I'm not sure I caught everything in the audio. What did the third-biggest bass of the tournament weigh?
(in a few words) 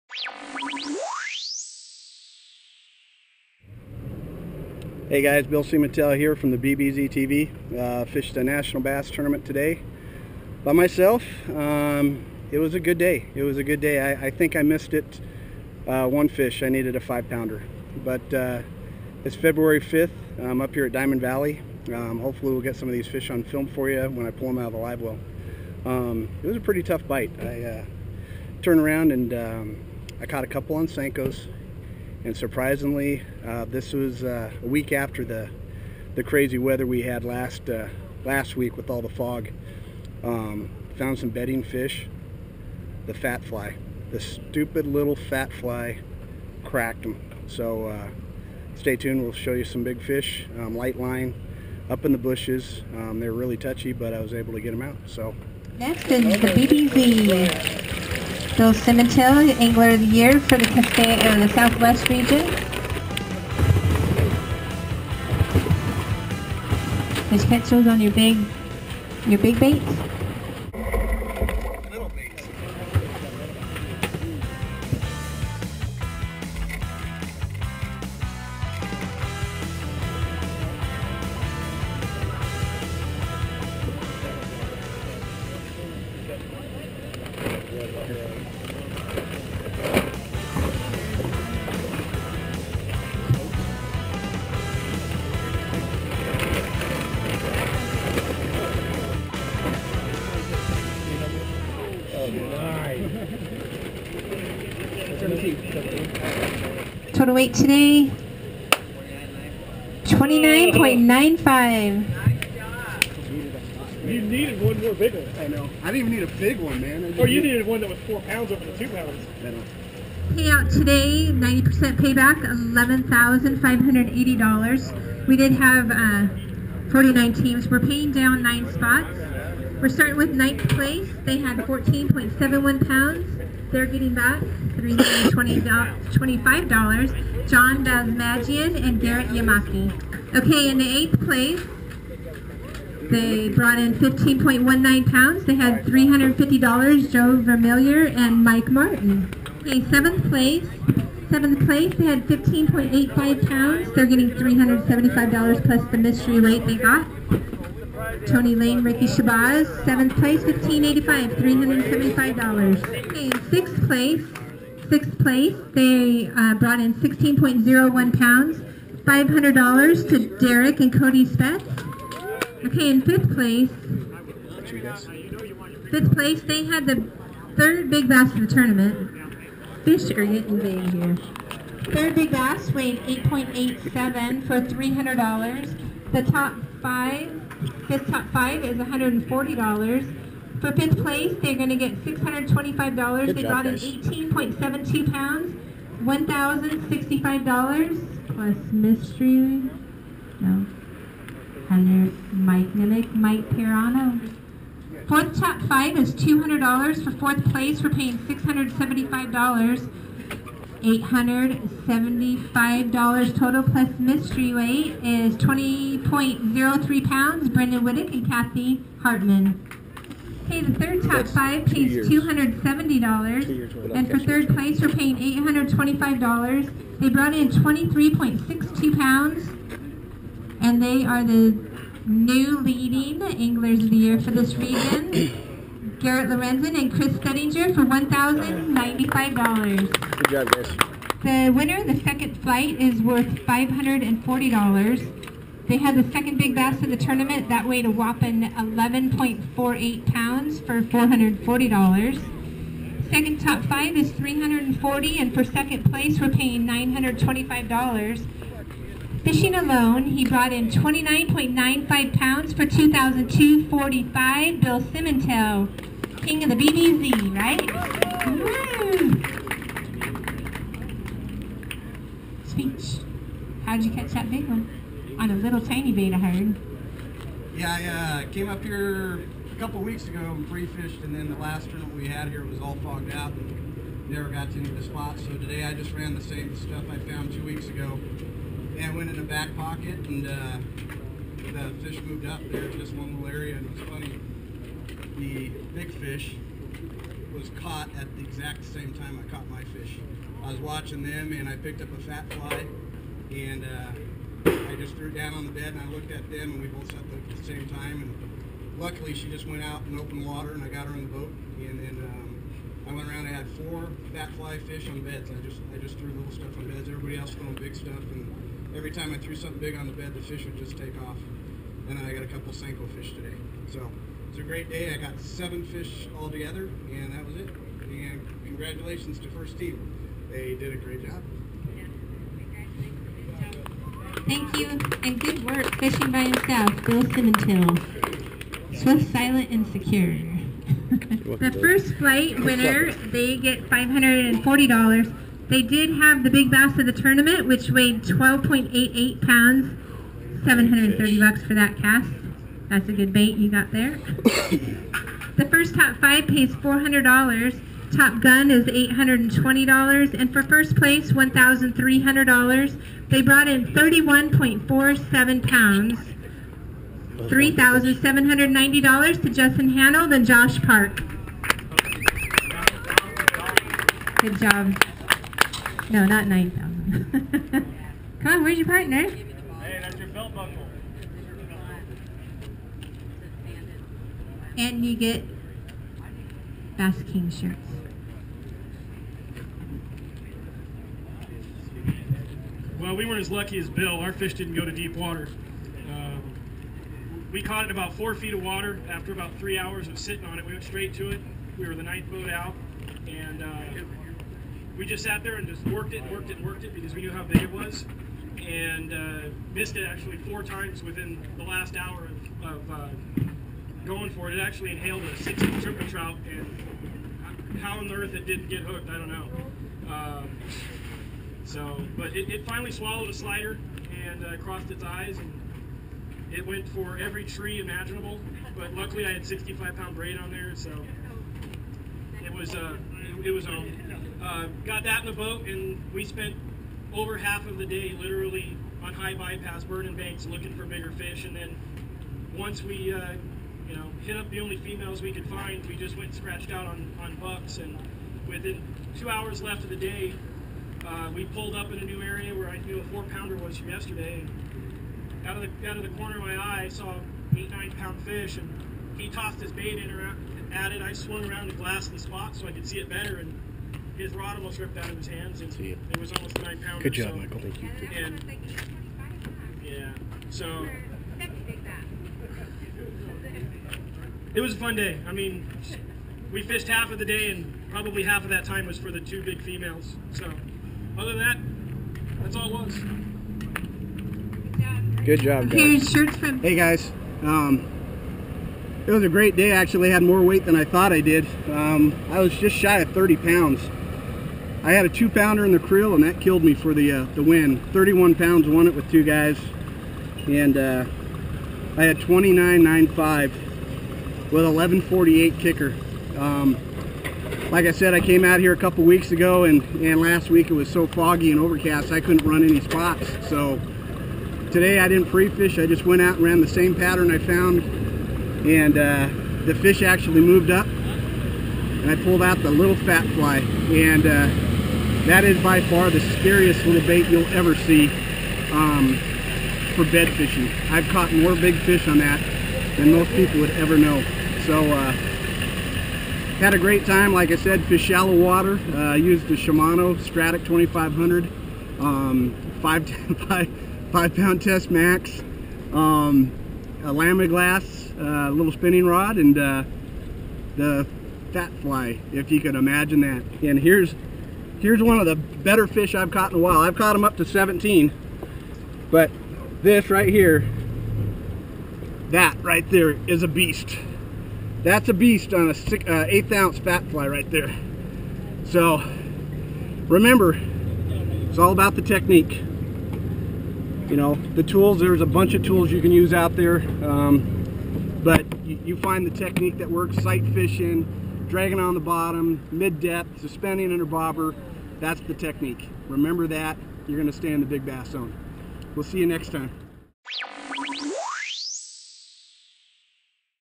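8.87.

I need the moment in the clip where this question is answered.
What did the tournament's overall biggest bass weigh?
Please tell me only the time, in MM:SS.
05:48.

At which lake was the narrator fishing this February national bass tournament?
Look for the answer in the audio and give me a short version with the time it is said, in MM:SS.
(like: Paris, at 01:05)
Diamond Valley, at 00:20.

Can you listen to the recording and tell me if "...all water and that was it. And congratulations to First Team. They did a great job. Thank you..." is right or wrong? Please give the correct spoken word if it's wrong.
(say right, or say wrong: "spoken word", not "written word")
wrong: "together", not "water".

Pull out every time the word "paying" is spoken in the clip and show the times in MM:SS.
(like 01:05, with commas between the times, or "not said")
02:07, 03:27, 03:44, 04:16.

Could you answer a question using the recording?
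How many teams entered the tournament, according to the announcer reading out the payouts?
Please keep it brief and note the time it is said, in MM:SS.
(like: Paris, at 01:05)
49, at 02:06.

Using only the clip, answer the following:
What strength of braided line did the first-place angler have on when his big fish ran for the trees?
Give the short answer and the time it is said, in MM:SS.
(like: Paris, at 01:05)
65-pound, at 07:09.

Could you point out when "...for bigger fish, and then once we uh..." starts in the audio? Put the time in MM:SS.
07:20.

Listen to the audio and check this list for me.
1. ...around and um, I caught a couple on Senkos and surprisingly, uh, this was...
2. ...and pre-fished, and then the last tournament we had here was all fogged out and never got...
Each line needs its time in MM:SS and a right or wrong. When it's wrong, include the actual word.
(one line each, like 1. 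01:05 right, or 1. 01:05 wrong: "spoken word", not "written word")
1. 00:28 right
2. 04:40 right.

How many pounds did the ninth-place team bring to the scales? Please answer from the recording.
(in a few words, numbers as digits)
14.71.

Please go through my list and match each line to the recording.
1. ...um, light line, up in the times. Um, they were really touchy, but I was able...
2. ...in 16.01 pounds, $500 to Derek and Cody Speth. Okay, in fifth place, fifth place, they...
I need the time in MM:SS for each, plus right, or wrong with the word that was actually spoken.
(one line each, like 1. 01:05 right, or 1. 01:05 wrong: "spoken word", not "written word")
1. 00:50 wrong: "bushes", not "times"
2. 02:46 right.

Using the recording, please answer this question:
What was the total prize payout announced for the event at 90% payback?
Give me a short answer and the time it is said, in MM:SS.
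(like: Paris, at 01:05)
$11,580, at 02:02.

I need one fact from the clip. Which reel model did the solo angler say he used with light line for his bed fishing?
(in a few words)
Shimano Stratic 2500.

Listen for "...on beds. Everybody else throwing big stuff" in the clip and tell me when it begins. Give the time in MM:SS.
05:16.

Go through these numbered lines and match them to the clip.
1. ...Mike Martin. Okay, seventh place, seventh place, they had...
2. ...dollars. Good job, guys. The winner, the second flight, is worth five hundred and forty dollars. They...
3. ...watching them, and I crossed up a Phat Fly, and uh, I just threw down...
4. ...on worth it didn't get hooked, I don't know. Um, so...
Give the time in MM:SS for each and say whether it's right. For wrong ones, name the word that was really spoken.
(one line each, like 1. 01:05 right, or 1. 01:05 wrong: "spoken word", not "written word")
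1. 02:28 right
2. 03:59 right
3. 05:00 wrong: "picked", not "crossed"
4. 06:57 wrong: "earth", not "worth".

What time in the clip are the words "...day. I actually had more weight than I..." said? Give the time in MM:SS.
08:09.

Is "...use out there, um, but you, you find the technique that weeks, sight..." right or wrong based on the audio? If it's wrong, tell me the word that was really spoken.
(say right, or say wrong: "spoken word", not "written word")
wrong: "works", not "weeks".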